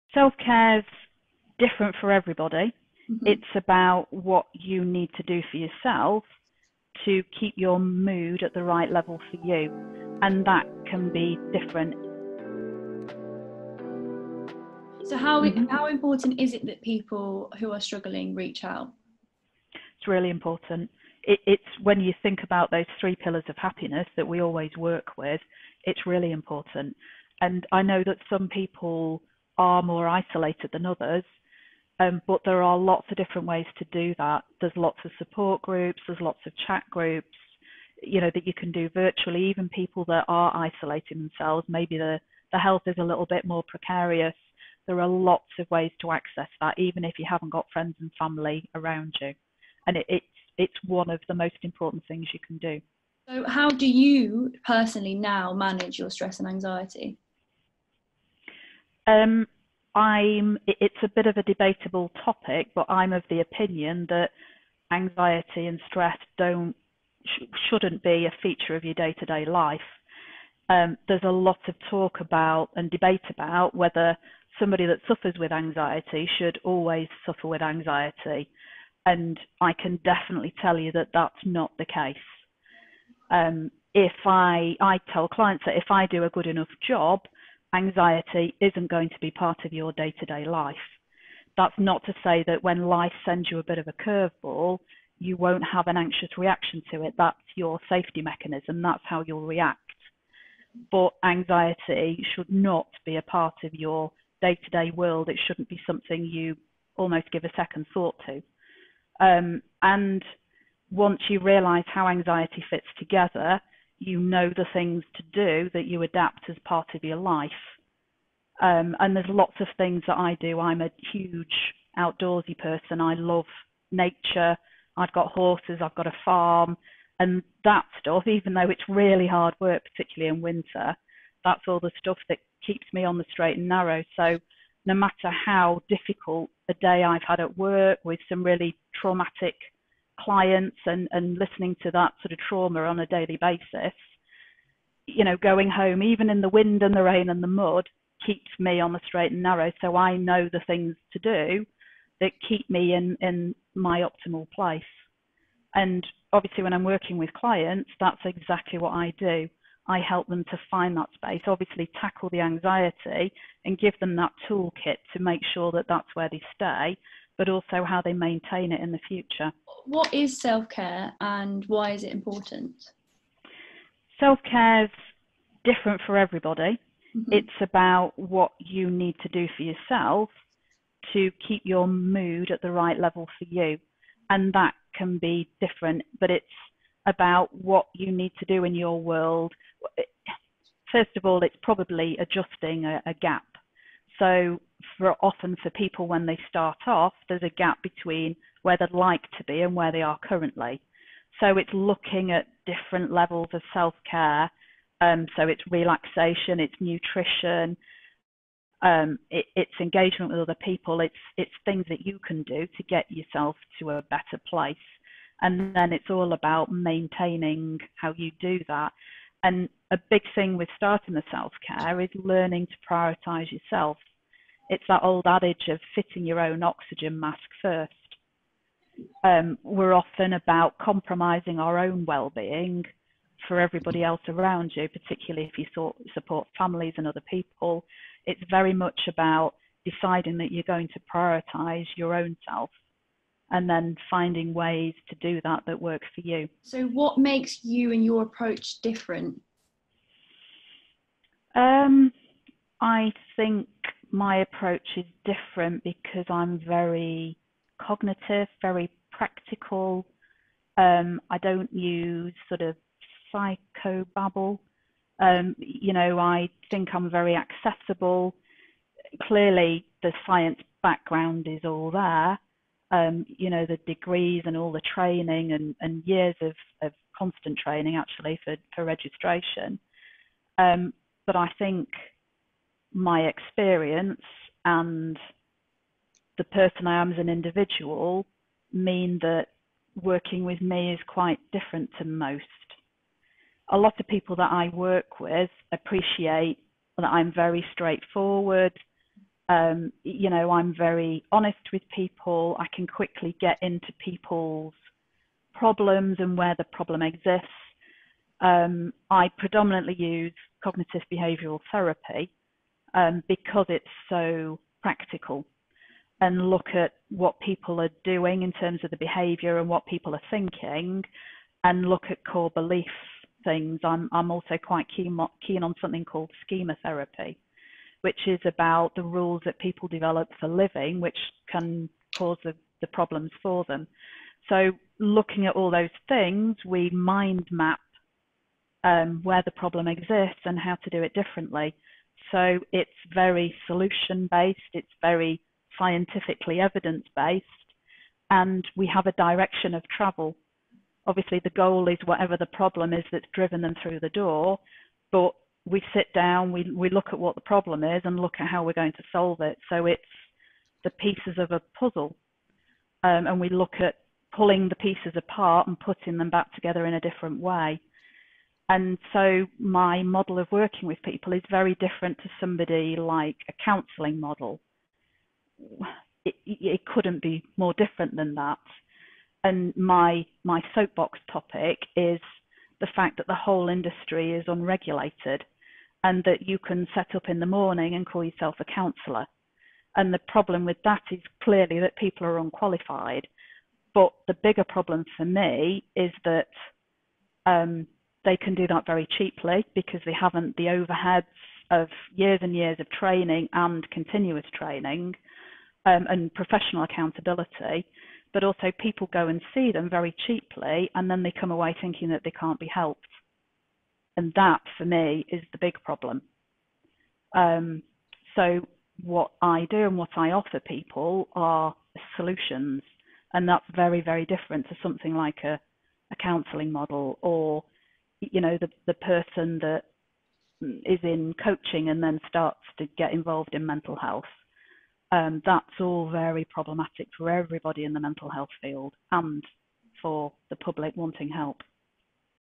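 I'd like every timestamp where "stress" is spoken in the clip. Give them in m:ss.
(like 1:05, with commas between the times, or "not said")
0:56, 1:05.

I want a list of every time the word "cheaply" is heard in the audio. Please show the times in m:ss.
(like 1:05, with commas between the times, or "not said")
6:39, 6:50.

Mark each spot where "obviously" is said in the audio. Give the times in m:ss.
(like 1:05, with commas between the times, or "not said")
2:36, 2:41, 5:51.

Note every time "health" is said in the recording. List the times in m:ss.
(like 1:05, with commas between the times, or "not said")
0:42, 7:13, 7:18.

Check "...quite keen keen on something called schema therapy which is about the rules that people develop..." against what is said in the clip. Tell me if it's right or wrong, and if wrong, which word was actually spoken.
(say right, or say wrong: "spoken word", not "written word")
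right.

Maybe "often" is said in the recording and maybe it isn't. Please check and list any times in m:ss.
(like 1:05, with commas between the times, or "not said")
3:15, 3:49.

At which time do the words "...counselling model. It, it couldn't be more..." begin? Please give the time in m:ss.
6:13.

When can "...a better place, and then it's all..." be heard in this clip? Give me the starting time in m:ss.
3:33.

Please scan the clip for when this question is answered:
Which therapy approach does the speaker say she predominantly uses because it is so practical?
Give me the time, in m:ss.
5:10.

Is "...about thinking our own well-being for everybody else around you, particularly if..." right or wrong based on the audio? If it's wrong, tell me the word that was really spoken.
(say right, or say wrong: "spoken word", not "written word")
wrong: "compromising", not "thinking".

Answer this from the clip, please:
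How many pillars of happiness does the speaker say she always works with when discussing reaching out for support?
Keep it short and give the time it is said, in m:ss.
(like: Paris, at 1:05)
3, at 0:22.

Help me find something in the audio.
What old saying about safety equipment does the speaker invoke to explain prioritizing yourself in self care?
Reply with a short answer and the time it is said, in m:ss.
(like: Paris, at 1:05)
Fitting your own oxygen mask first, at 3:45.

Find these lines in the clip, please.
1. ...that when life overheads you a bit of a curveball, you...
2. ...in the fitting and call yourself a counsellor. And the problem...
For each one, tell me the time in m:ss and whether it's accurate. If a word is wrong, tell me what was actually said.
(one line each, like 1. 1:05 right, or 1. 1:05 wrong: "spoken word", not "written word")
1. 1:32 wrong: "sends", not "overheads"
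2. 6:27 wrong: "morning", not "fitting".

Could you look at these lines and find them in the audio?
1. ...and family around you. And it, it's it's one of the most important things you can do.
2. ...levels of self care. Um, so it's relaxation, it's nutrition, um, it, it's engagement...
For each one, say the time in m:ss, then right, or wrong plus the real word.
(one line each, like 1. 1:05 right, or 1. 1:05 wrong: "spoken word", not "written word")
1. 0:48 right
2. 3:23 right.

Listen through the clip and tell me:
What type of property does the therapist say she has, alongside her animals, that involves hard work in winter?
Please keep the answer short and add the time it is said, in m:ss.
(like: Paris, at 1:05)
A farm, at 2:06.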